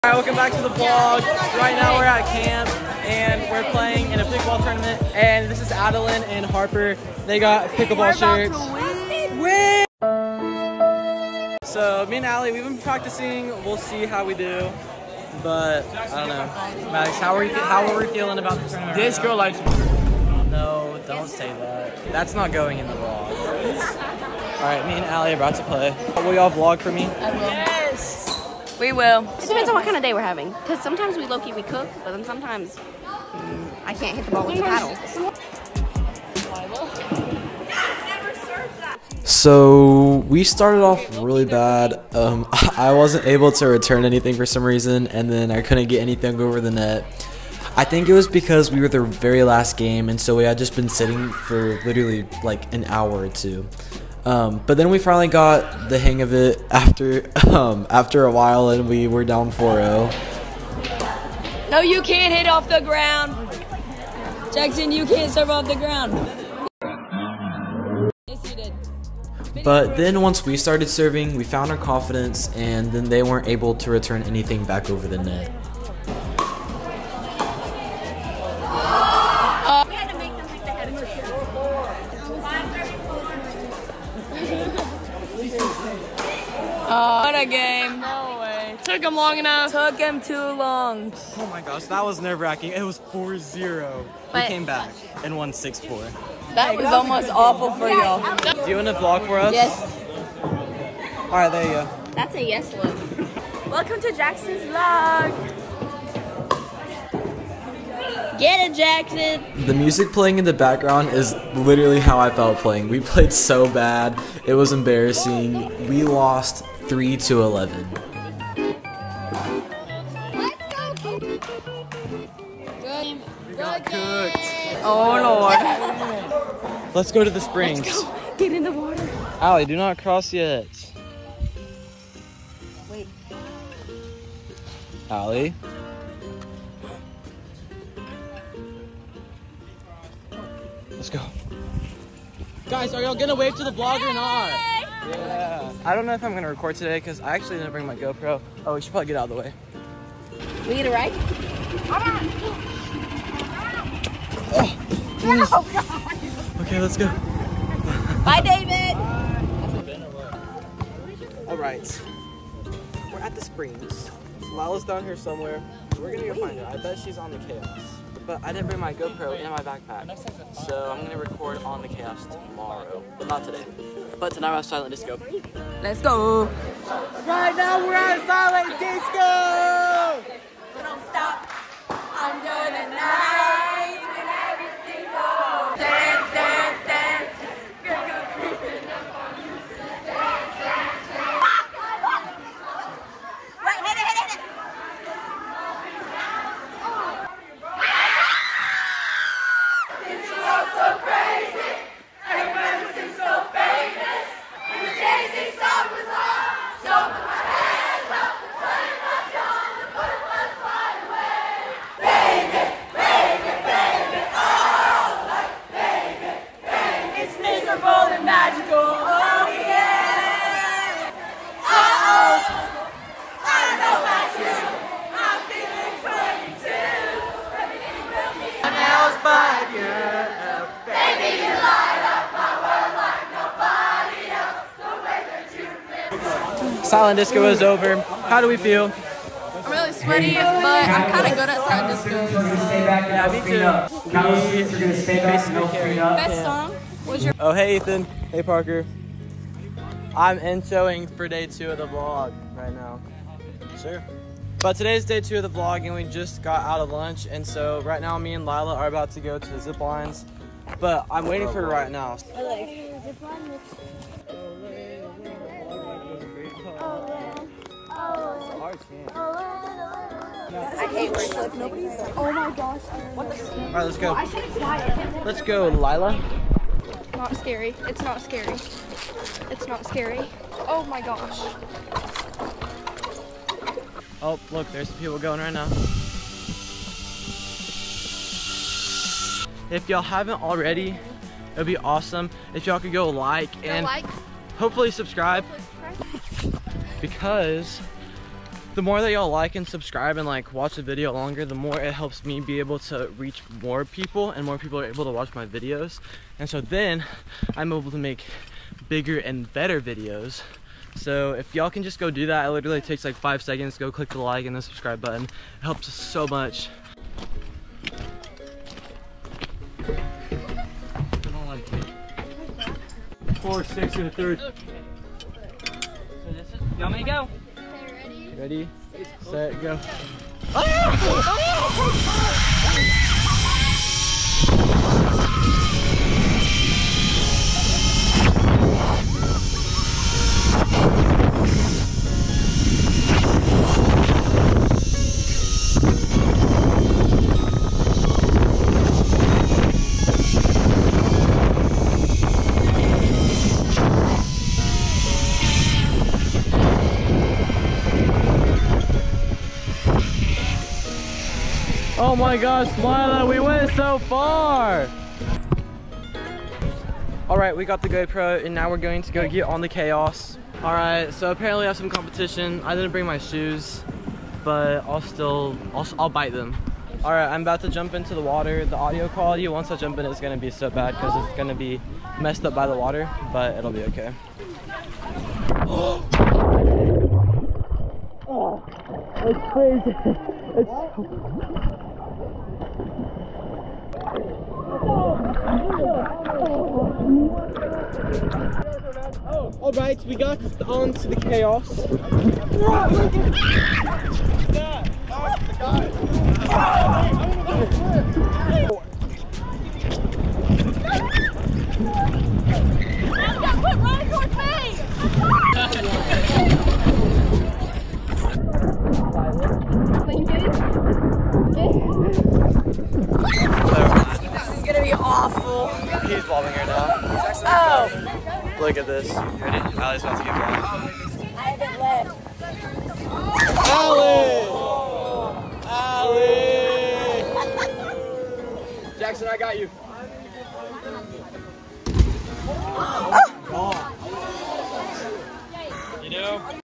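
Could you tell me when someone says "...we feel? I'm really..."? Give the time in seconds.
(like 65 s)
238 s.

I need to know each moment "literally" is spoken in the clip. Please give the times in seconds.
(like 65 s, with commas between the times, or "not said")
51 s, 111 s, 312 s.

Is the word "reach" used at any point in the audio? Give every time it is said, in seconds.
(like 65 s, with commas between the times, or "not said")
303 s.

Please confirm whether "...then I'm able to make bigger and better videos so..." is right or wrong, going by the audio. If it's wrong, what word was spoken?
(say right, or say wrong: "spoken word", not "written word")
right.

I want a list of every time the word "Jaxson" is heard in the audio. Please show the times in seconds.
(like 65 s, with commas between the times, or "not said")
64 s, 104 s, 108 s, 438 s.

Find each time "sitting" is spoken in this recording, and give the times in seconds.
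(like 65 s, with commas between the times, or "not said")
50 s.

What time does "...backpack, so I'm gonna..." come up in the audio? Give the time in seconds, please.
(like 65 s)
169 s.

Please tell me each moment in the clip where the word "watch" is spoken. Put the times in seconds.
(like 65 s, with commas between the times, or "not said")
300 s, 305 s.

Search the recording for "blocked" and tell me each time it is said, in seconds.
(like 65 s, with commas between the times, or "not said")
430 s.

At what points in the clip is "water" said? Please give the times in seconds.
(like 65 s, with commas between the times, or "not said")
128 s, 378 s, 382 s.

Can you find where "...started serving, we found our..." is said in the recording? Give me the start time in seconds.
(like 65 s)
70 s.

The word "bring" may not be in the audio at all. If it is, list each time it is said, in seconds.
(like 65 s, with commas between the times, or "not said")
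147 s, 168 s, 372 s.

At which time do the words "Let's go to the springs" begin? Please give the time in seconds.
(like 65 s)
126 s.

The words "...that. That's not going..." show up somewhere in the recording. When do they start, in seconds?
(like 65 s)
21 s.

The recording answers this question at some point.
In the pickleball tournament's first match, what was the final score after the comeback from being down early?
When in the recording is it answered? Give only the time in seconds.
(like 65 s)
95 s.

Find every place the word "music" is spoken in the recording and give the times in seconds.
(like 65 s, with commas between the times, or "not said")
109 s.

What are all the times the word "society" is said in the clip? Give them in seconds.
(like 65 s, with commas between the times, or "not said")
not said.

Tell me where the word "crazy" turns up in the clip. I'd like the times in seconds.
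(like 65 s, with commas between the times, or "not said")
389 s.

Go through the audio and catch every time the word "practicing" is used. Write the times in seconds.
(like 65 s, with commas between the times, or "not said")
12 s.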